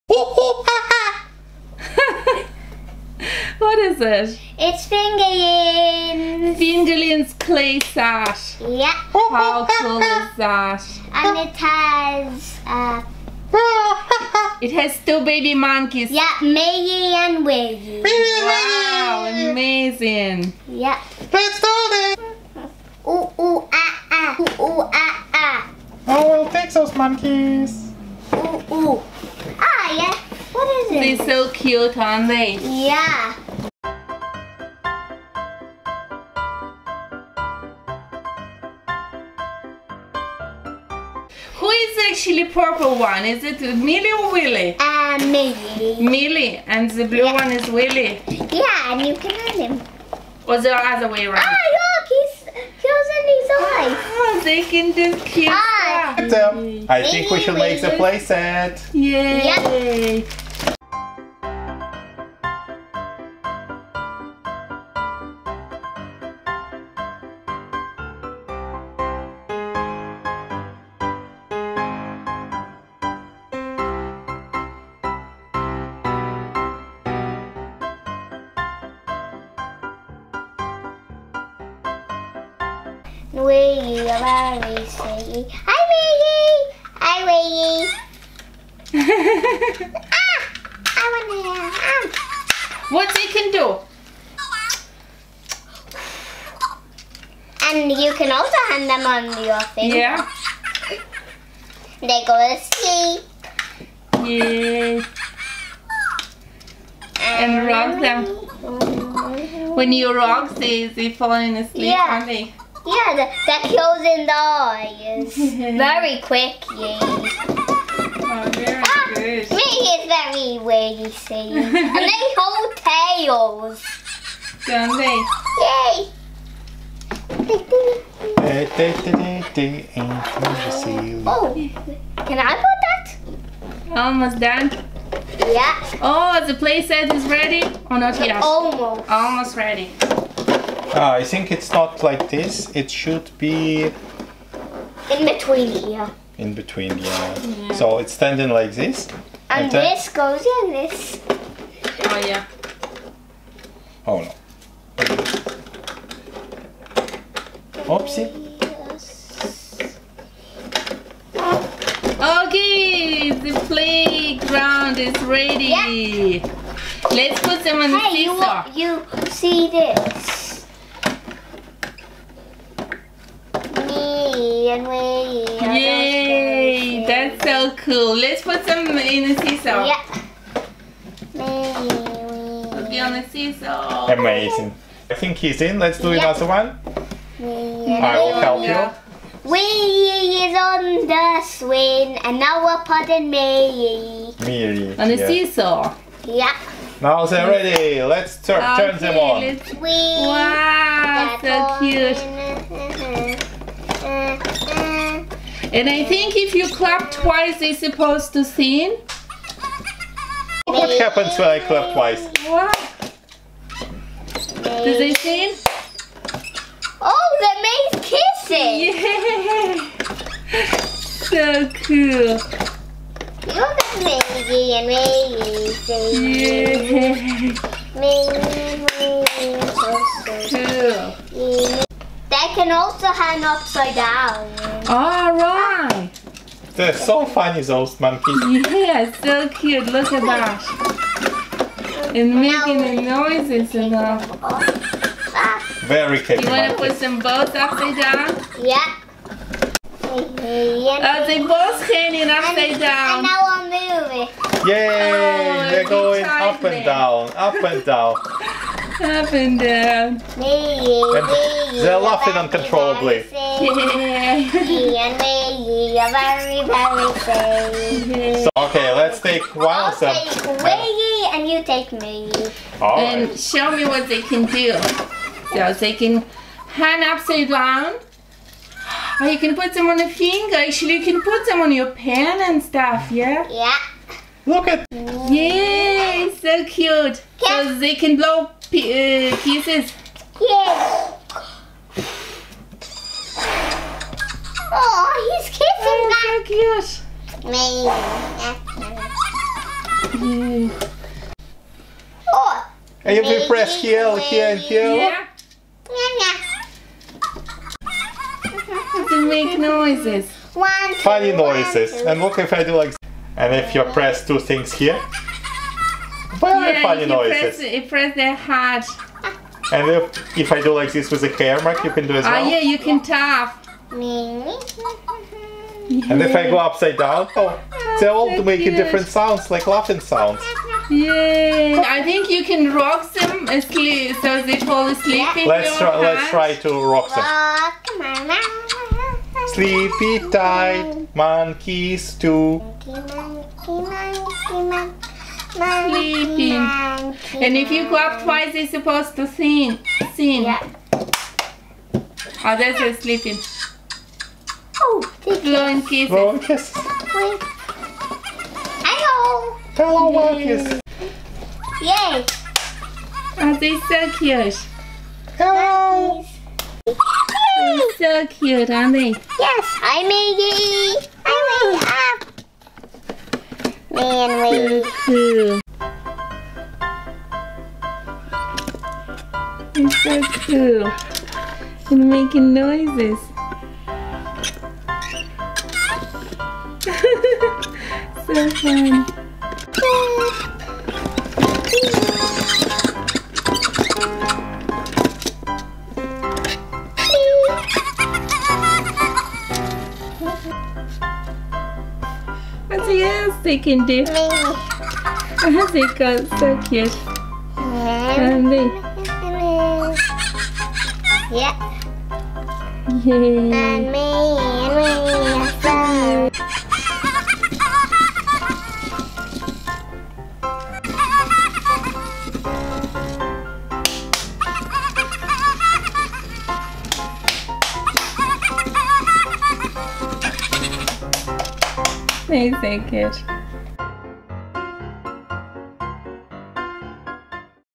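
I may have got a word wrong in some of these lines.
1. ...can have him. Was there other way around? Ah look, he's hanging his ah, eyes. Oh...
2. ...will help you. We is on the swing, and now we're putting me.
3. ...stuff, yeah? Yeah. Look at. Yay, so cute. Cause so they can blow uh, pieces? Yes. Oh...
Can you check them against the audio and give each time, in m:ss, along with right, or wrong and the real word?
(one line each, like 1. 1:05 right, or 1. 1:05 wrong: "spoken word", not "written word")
1. 0:49 wrong: "closing", not "hanging"
2. 3:08 right
3. 4:42 right.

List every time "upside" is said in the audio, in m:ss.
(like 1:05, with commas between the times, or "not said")
3:53, 4:07, 4:12, 4:37, 5:26.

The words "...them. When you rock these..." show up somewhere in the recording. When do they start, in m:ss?
1:48.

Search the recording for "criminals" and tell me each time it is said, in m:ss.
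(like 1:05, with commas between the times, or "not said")
not said.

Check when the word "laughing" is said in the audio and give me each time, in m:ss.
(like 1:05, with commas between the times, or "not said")
4:21, 5:29.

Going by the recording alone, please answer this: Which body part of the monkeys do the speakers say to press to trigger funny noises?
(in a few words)
Heart.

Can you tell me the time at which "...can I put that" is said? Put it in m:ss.
2:12.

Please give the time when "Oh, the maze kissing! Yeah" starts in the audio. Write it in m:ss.
3:37.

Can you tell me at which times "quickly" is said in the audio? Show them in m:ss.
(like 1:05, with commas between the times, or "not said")
1:56.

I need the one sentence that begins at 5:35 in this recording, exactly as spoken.
in let's try, Let's try to rock them.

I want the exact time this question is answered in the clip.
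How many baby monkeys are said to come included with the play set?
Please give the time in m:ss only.
0:15.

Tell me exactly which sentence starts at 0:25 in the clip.
I oh, will take those monkeys.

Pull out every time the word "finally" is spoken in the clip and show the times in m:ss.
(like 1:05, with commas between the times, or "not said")
not said.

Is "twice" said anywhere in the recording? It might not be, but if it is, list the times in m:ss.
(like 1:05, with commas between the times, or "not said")
3:27, 3:31, 5:48.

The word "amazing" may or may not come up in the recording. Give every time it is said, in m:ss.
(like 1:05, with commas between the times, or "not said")
0:19, 3:04, 5:00.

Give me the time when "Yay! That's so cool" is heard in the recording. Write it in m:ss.
2:55.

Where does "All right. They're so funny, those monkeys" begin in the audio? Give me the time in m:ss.
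3:54.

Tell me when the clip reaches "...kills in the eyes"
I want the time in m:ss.
1:53.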